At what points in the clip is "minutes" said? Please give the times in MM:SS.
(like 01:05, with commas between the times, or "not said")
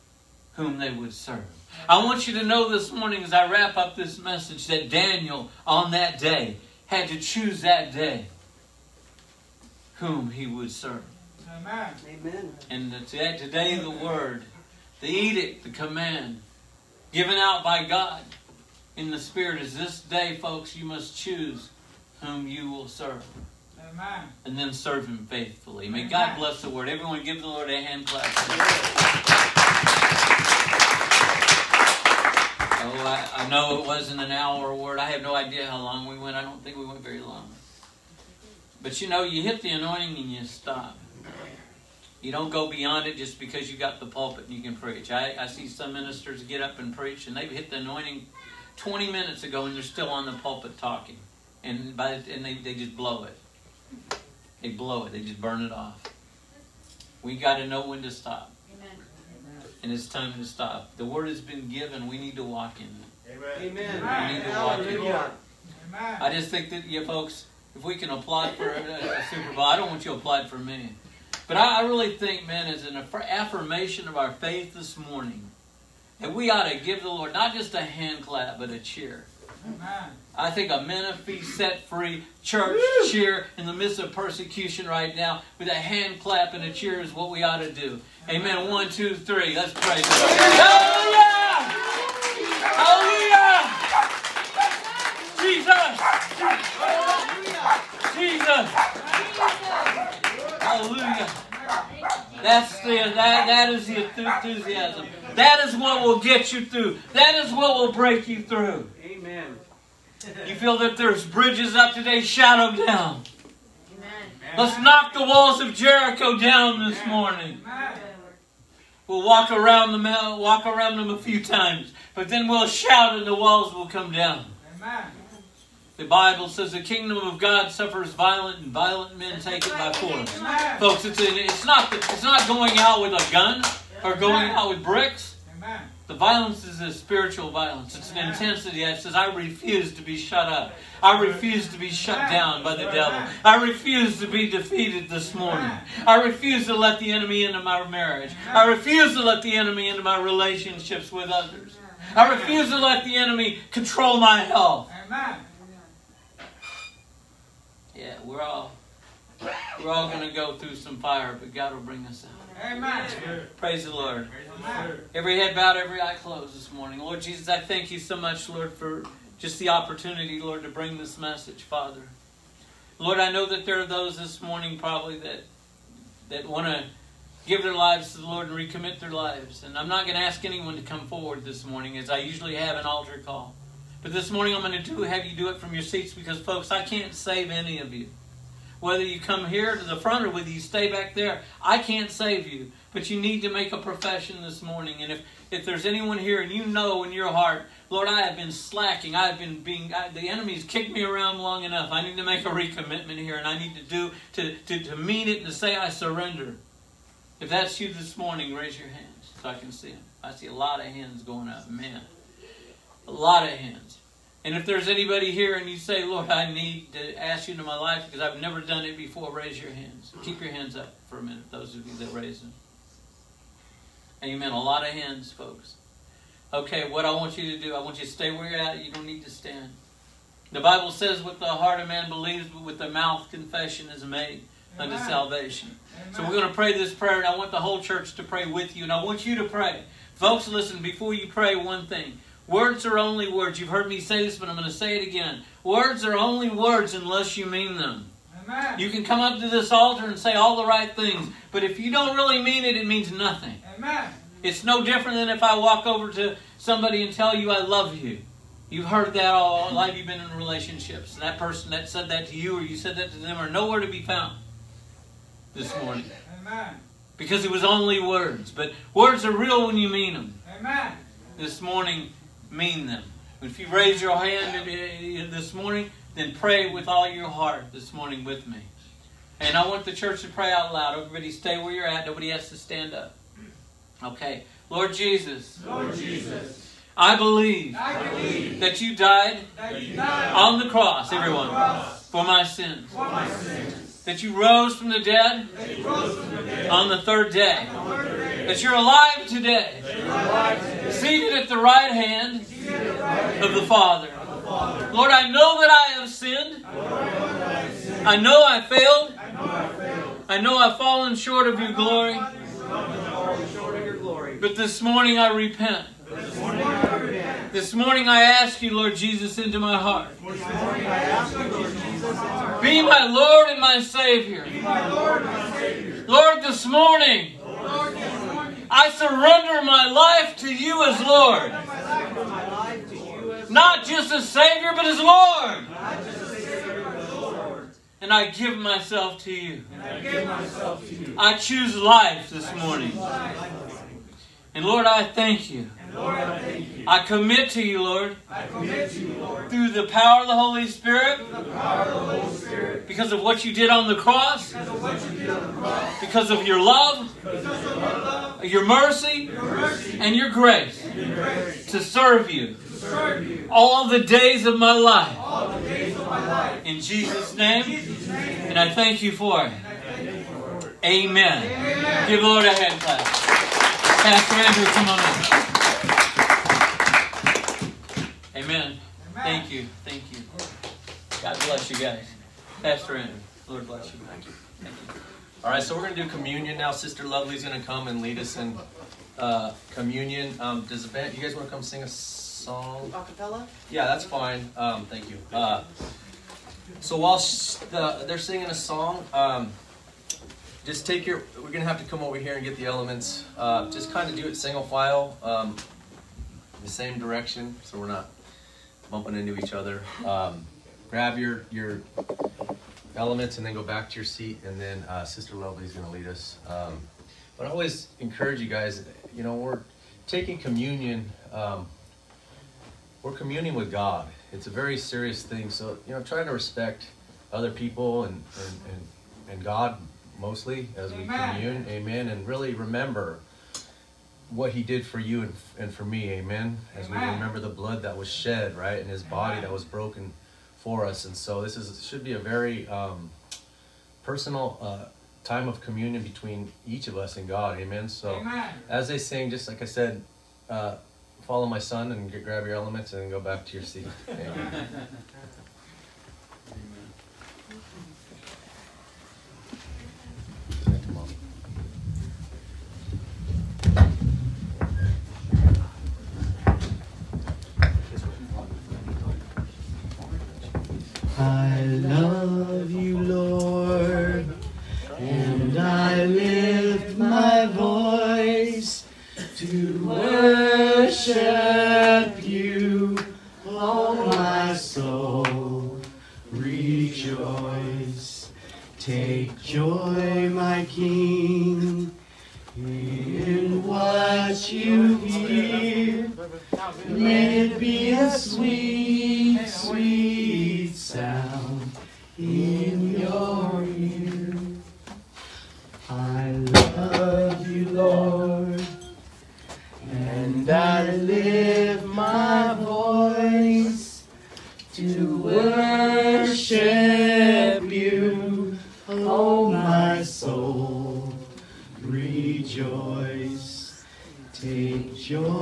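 00:49, 03:41.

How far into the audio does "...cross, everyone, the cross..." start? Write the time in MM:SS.
04:50.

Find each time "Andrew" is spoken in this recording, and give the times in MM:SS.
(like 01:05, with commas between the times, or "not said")
06:14, 06:22.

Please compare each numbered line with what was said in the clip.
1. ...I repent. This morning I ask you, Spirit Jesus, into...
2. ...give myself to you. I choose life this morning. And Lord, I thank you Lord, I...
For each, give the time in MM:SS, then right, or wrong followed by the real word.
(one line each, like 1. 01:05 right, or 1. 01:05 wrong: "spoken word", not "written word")
1. 05:15 wrong: "Lord", not "Spirit"
2. 05:38 right.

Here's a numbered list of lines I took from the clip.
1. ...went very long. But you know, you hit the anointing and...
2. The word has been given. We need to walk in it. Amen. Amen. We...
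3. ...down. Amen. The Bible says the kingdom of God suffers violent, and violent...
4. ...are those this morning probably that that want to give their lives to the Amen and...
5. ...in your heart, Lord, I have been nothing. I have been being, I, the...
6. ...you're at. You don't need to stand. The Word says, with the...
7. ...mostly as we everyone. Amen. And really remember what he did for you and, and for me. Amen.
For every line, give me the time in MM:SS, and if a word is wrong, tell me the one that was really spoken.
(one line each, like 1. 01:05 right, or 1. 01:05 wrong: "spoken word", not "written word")
1. 00:36 right
2. 01:00 right
3. 02:04 right
4. 02:53 wrong: "Lord", not "Amen"
5. 03:17 wrong: "slacking", not "nothing"
6. 03:48 wrong: "Bible", not "Word"
7. 07:10 wrong: "commune", not "everyone".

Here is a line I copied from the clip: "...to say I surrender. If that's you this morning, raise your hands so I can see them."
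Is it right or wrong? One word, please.
right.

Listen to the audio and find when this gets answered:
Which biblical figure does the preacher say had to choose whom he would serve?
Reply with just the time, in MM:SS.
00:04.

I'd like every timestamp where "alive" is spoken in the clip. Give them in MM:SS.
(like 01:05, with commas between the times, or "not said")
04:58.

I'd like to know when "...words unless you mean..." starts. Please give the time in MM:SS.
04:06.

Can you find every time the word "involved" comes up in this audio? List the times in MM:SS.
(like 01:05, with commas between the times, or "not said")
not said.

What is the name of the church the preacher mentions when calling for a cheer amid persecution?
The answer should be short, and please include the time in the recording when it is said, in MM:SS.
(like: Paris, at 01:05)
Menifee Set Free, at 01:20.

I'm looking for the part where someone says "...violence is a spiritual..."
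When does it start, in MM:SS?
02:16.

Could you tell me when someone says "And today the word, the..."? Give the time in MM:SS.
00:12.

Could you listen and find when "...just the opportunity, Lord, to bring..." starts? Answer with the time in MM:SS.
02:49.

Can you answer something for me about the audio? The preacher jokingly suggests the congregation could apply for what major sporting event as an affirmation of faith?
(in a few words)
Super Bowl.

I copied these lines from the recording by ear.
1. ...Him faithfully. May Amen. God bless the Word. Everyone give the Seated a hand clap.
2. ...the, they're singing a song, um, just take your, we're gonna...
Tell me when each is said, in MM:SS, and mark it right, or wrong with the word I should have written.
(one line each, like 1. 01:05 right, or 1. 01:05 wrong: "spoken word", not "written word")
1. 00:25 wrong: "Lord", not "Seated"
2. 06:37 right.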